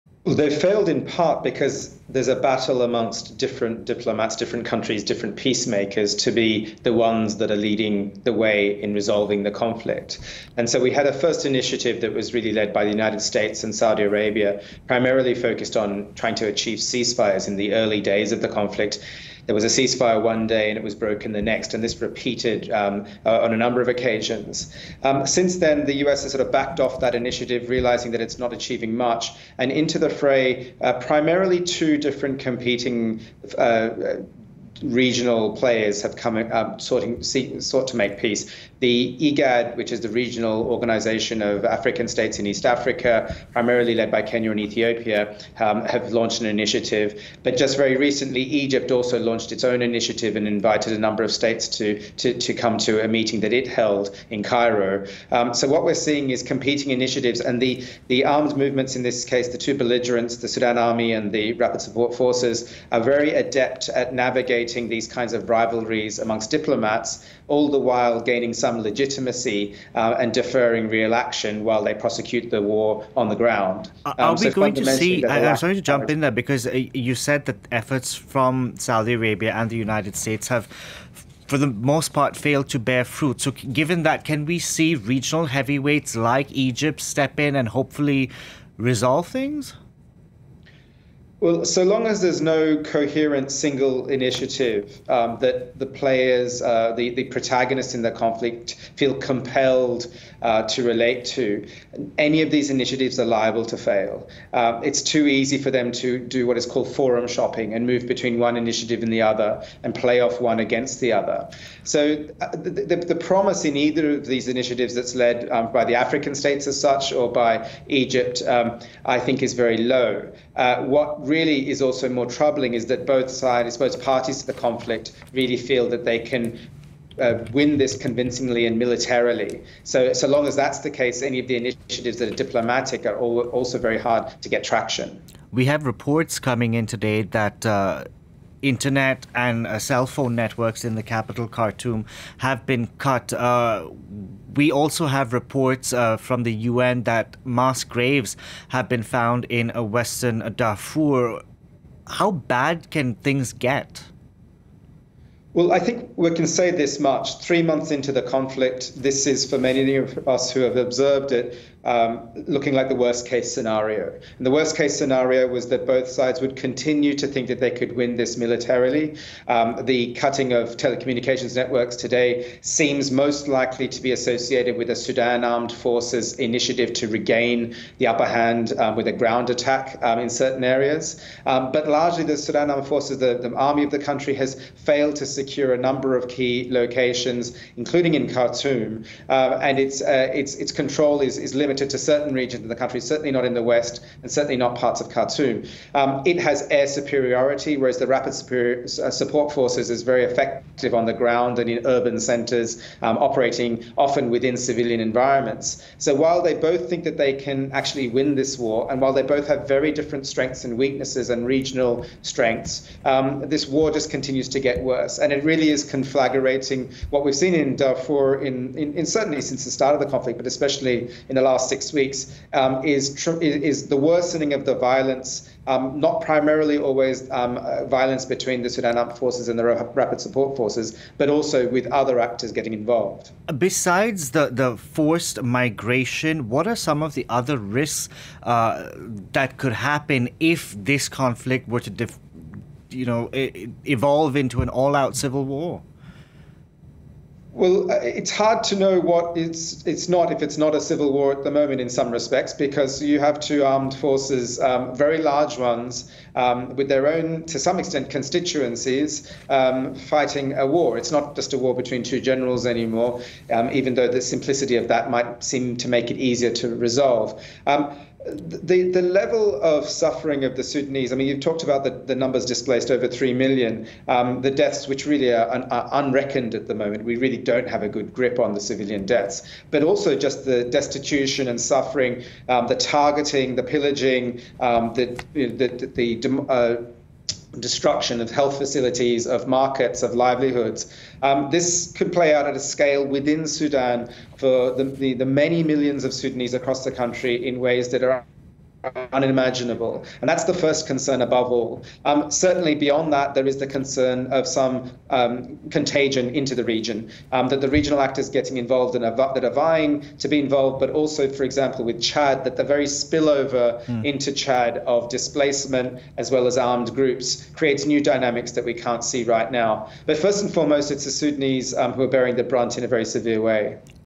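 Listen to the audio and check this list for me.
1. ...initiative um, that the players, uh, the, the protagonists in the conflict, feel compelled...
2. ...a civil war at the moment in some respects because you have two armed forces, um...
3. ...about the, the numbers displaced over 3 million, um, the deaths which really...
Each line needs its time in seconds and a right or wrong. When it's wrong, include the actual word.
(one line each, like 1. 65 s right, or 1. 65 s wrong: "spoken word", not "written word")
1. 94 s right
2. 250 s right
3. 271 s right.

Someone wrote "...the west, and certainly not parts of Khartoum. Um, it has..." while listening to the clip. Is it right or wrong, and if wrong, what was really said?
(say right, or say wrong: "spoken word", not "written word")
right.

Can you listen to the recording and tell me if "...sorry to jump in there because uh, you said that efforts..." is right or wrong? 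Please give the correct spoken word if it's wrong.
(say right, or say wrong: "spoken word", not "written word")
right.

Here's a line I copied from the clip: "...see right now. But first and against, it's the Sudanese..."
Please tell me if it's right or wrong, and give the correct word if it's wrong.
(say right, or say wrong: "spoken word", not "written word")
wrong: "foremost", not "against".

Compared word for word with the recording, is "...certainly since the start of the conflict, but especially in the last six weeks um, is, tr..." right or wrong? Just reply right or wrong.
right.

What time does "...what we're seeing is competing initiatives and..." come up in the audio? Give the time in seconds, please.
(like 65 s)
55 s.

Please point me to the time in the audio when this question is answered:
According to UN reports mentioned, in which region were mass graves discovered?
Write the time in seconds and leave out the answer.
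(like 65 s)
149 s.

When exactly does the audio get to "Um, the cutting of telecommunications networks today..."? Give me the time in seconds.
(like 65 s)
169 s.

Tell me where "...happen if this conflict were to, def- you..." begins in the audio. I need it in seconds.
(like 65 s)
239 s.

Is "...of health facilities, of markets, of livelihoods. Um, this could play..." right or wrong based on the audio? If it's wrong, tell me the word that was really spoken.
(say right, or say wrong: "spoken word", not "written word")
right.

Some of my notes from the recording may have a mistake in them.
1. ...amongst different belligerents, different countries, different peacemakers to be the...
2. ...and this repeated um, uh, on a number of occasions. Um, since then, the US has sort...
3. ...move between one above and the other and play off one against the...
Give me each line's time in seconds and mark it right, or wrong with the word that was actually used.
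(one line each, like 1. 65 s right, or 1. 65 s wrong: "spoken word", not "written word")
1. 2 s wrong: "diplomats", not "belligerents"
2. 21 s right
3. 107 s wrong: "initiative", not "above".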